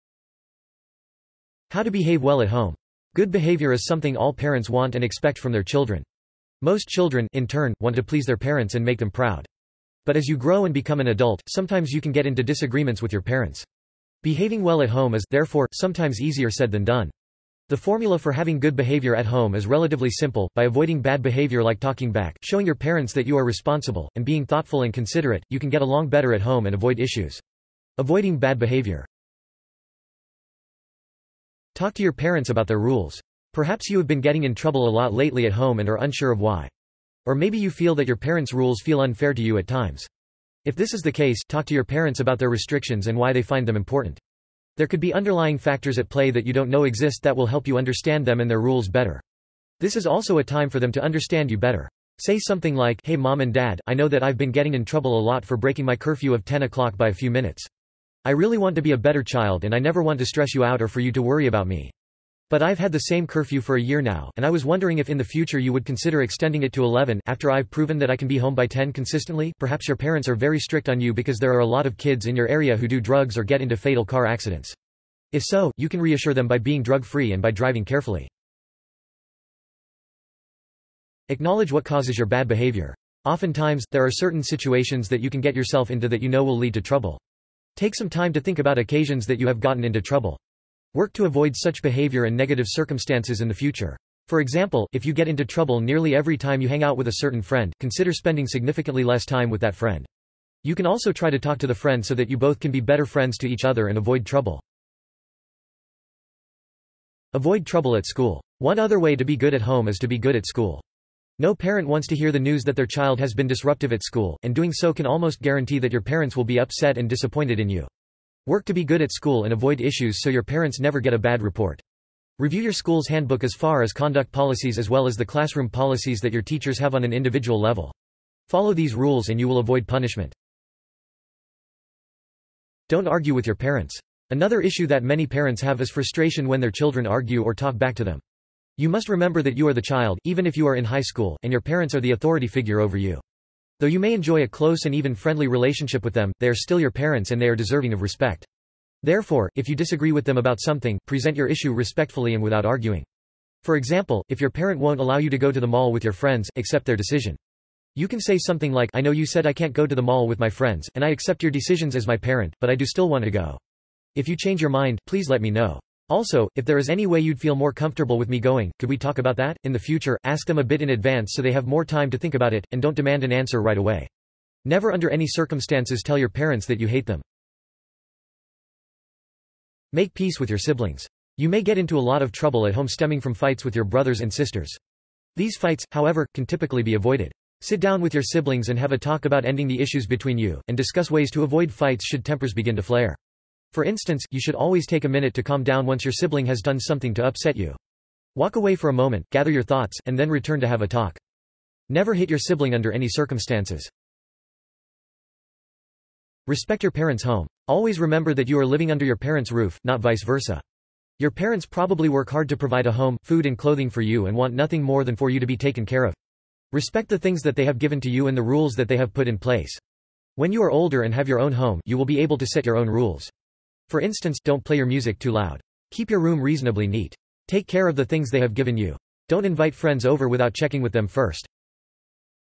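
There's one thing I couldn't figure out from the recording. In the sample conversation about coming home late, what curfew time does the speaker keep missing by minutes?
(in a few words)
10 o'clock.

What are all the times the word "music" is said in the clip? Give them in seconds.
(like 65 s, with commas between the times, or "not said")
224 s.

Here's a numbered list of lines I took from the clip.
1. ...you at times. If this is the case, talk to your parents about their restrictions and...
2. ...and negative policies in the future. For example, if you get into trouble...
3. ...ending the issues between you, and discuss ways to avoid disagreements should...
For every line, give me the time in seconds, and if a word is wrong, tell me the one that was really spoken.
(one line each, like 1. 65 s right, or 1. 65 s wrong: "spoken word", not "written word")
1. 39 s right
2. 92 s wrong: "circumstances", not "policies"
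3. 189 s wrong: "fights", not "disagreements".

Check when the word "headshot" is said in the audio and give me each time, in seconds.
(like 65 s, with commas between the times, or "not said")
not said.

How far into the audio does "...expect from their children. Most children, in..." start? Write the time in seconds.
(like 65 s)
5 s.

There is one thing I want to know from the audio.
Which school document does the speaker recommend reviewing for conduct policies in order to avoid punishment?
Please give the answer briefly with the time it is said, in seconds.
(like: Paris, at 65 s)
school's handbook, at 122 s.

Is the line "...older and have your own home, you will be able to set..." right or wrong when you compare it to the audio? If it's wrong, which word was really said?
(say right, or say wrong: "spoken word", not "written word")
right.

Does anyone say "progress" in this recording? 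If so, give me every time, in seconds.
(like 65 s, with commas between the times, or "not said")
not said.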